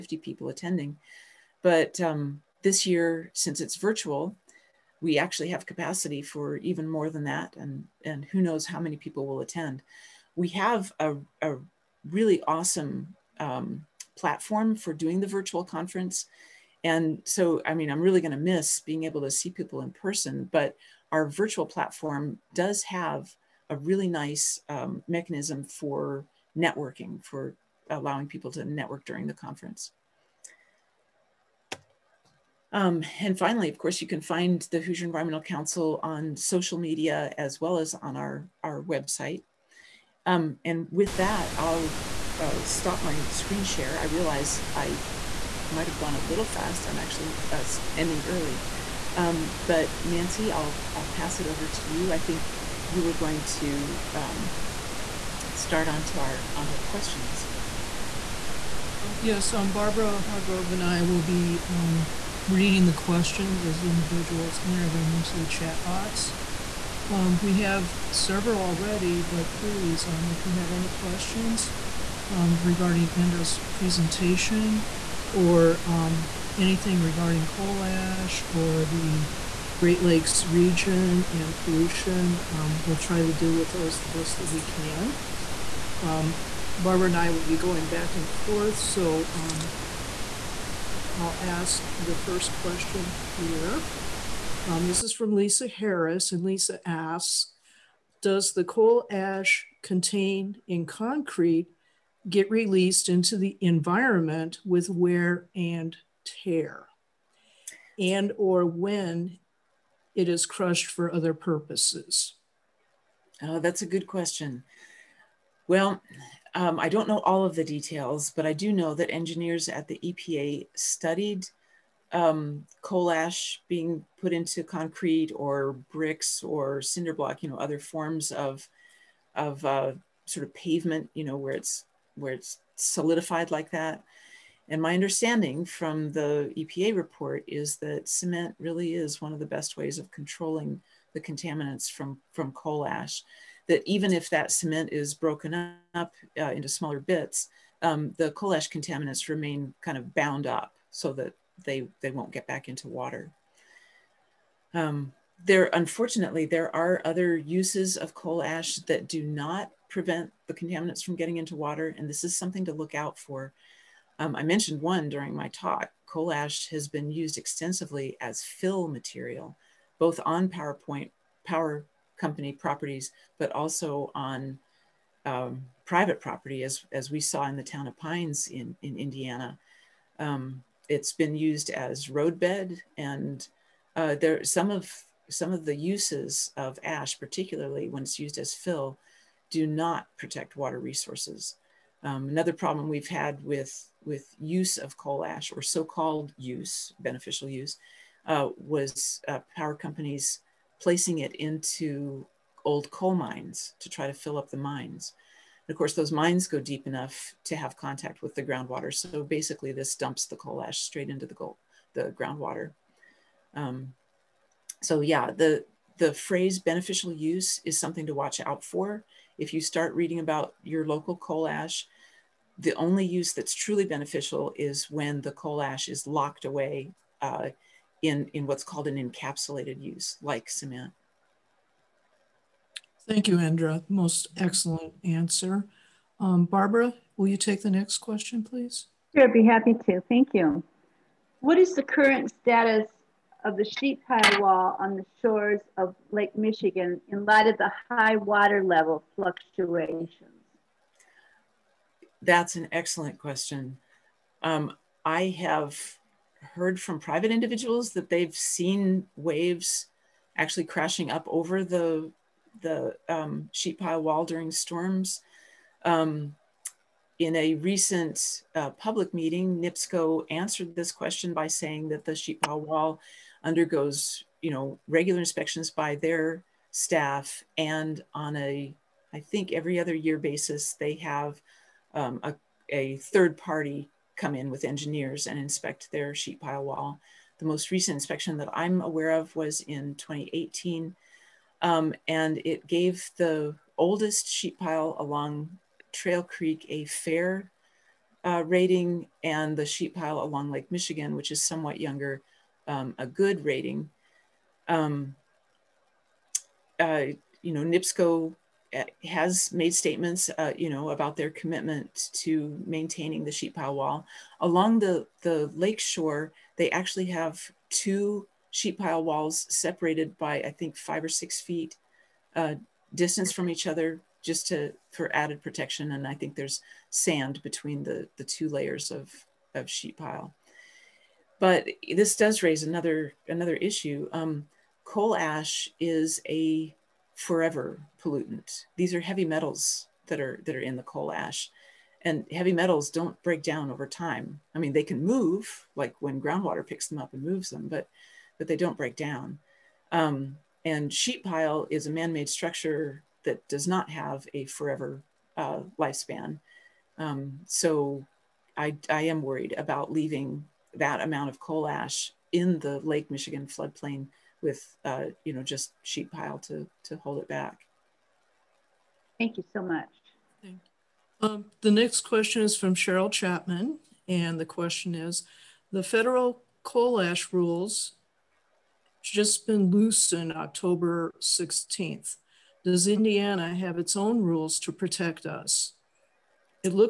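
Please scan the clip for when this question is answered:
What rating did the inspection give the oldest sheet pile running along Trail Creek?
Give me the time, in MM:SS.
04:56.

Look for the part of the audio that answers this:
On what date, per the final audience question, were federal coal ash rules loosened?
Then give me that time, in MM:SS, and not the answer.
06:20.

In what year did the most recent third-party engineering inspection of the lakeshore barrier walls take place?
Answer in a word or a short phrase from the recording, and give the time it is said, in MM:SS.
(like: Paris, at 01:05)
2018, at 04:49.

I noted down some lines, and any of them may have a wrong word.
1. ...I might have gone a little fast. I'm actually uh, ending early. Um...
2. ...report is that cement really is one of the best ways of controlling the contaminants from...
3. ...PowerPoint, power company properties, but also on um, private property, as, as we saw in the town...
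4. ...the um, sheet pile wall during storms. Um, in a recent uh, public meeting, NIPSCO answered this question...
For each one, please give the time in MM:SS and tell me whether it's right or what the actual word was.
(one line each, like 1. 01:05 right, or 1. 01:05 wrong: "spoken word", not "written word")
1. 00:44 right
2. 02:16 right
3. 02:50 right
4. 04:22 right.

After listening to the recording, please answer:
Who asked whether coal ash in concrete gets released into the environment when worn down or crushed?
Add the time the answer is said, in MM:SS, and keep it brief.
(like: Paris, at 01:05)
Lisa Harris, at 01:35.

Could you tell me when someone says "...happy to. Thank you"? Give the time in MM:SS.
03:59.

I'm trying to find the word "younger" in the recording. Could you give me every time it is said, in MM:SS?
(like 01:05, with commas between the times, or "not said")
05:01.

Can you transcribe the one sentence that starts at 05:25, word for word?
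And I think there's sand between the, the two layers of, of sheet pile.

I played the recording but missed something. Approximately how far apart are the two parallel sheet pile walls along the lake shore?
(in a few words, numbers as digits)
5 or 6 feet.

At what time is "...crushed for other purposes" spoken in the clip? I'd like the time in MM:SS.
01:50.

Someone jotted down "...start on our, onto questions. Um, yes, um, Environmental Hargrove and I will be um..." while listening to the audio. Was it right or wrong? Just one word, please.
wrong.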